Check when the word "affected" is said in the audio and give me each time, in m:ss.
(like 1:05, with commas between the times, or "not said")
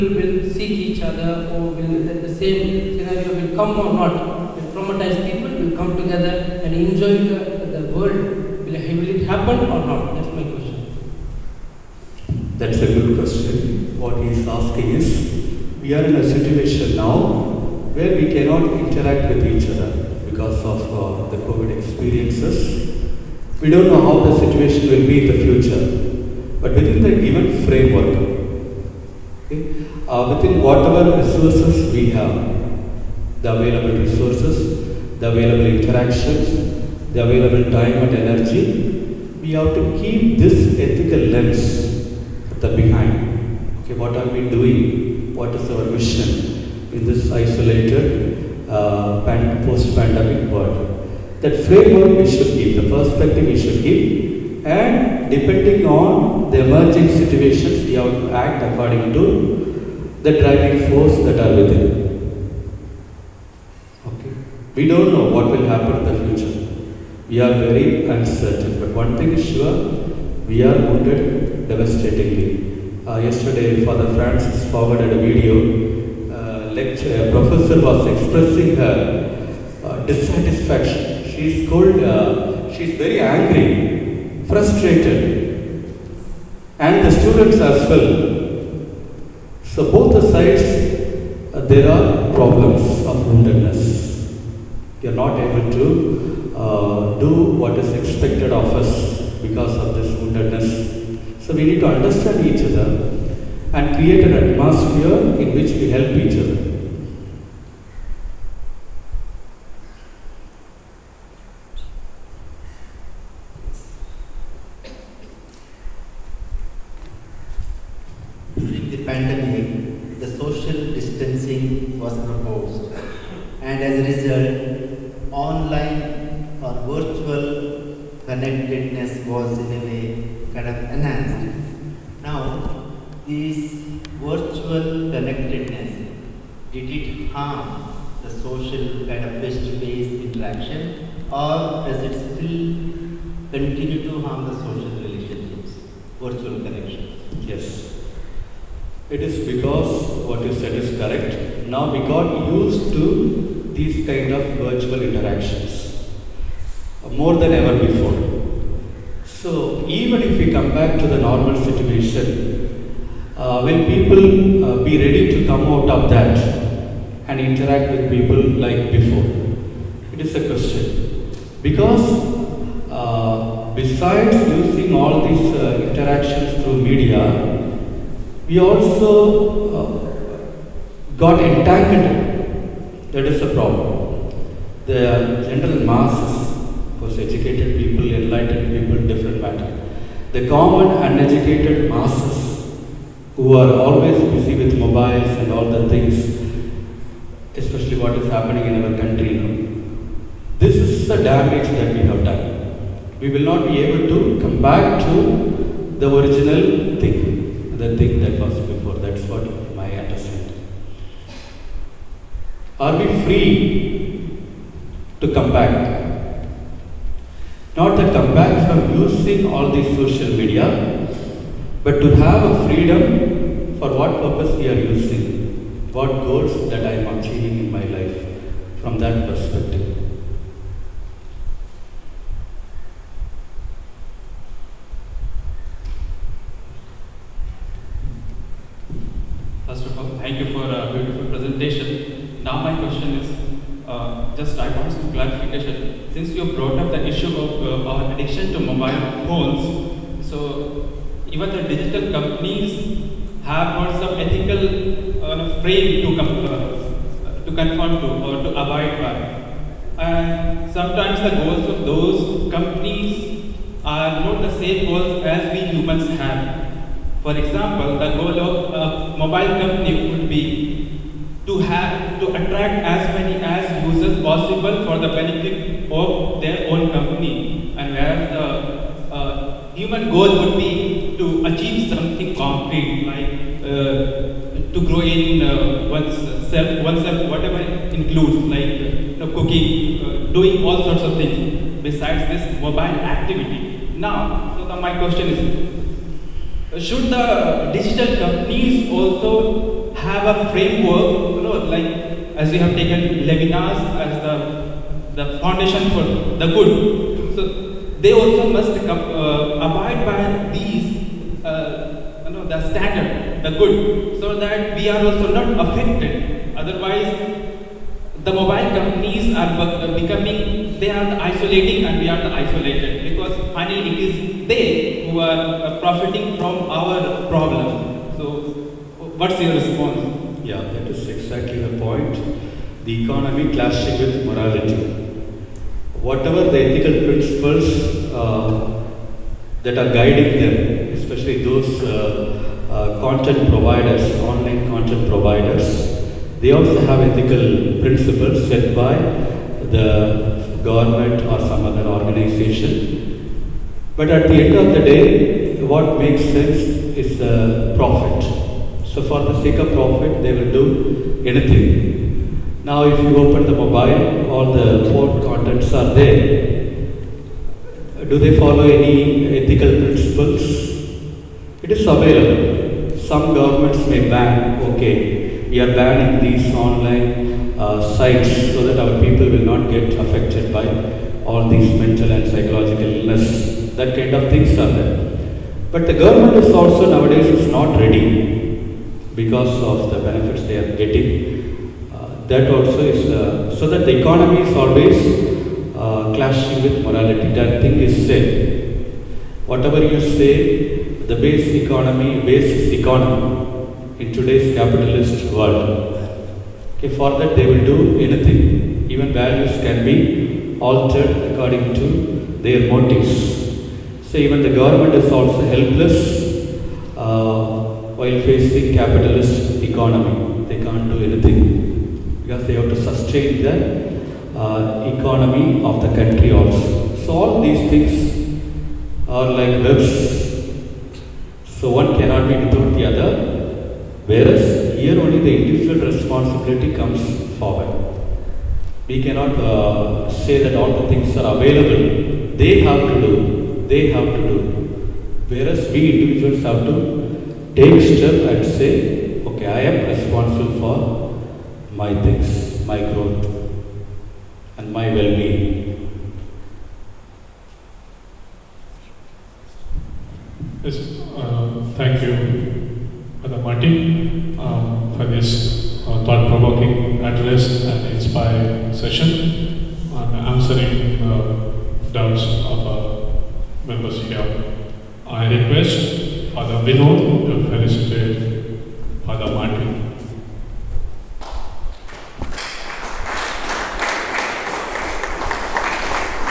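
5:15, 6:20.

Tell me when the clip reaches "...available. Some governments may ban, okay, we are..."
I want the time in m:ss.
6:11.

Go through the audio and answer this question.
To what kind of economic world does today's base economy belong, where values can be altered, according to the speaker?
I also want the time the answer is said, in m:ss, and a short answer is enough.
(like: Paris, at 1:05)
Capitalist world, at 6:44.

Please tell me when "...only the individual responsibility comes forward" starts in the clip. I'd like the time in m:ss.
7:15.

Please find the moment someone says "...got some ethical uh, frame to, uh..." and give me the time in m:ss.
4:13.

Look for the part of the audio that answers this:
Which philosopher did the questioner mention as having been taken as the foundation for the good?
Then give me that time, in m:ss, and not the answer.
5:03.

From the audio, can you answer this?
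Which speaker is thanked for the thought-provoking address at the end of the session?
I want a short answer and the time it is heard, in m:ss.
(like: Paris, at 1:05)
Brother Martin, at 7:43.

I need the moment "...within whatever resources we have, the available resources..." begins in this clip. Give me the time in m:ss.
0:30.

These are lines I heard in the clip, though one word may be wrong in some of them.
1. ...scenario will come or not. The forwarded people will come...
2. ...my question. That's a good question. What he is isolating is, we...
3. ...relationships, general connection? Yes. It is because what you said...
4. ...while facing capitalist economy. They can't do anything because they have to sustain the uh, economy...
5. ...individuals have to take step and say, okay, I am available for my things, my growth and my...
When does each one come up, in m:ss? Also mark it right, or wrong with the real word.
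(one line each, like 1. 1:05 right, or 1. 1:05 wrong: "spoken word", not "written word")
1. 0:02 wrong: "traumatized", not "forwarded"
2. 0:10 wrong: "asking", not "isolating"
3. 2:25 wrong: "virtual", not "general"
4. 6:57 right
5. 7:25 wrong: "responsible", not "available".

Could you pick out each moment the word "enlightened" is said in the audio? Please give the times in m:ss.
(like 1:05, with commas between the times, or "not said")
3:08.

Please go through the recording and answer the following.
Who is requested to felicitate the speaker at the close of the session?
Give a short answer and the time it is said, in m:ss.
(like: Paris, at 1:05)
Father Vinod, at 7:56.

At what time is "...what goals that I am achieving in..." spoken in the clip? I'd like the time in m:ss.
3:45.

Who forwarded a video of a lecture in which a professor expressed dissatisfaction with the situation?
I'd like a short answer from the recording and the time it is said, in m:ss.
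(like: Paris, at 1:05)
Father Francis, at 1:13.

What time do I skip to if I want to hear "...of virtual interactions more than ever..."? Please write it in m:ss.
2:34.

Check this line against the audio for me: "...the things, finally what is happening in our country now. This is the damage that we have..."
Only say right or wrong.
wrong.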